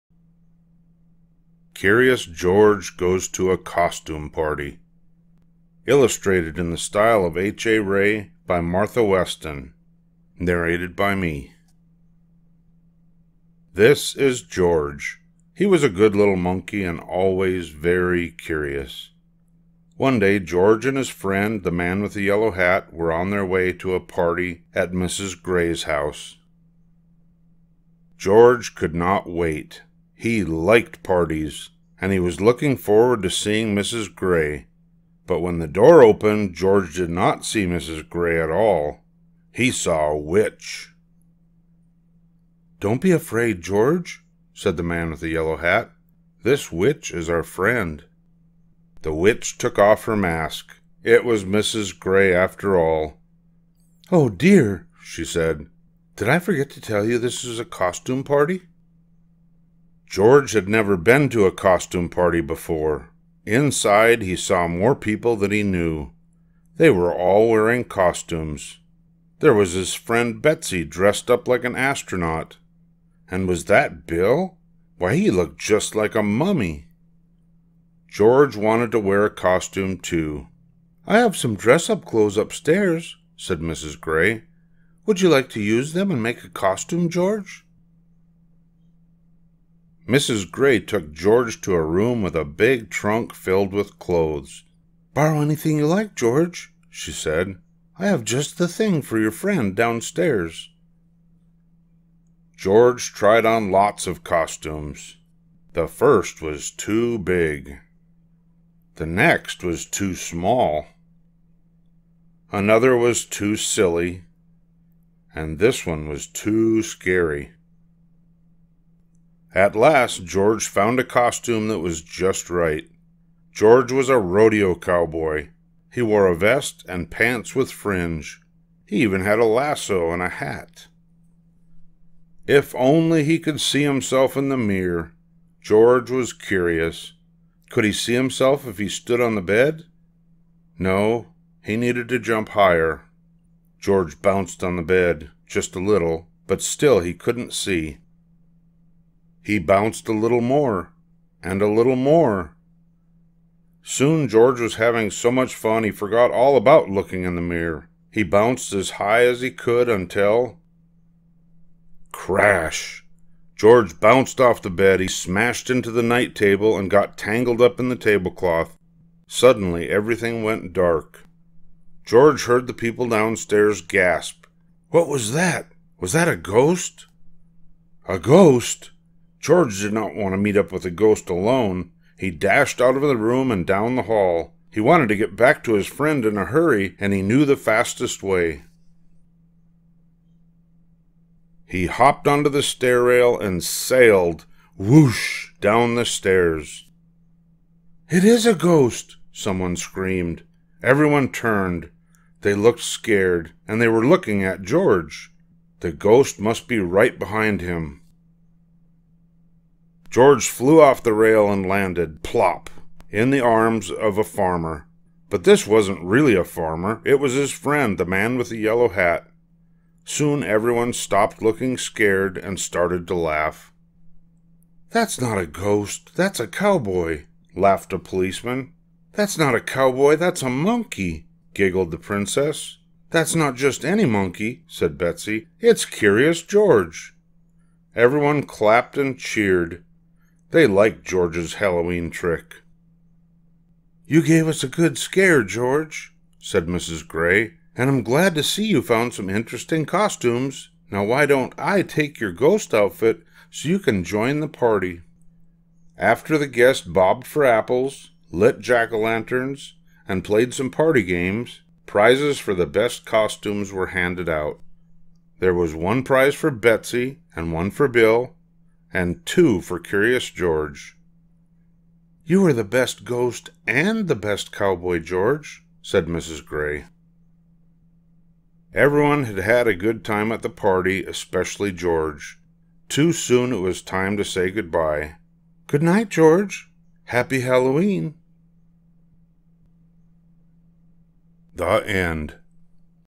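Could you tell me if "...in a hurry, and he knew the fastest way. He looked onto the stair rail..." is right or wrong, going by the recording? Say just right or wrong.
wrong.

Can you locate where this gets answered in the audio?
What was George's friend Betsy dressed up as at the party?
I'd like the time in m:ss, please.
1:11.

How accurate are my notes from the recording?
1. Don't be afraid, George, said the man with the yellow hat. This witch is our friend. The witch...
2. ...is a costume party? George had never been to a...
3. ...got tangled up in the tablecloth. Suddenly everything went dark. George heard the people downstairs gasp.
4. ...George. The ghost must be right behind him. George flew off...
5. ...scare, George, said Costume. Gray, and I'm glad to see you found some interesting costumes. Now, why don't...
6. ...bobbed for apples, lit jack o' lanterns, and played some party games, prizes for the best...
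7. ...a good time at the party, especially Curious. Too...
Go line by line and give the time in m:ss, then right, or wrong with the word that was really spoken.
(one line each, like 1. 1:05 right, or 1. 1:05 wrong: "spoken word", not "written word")
1. 0:42 right
2. 0:57 right
3. 2:46 right
4. 3:24 right
5. 4:04 wrong: "Mrs", not "Costume"
6. 4:16 right
7. 4:39 wrong: "George", not "Curious".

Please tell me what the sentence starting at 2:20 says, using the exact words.
No, he needed to jump higher.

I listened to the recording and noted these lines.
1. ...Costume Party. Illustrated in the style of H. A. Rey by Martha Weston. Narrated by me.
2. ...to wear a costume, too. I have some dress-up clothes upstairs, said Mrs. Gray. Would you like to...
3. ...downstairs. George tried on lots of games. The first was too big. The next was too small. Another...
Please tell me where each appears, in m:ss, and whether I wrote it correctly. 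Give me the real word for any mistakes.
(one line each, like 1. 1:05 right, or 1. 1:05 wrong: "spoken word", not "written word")
1. 0:03 right
2. 1:18 right
3. 1:39 wrong: "costumes", not "games".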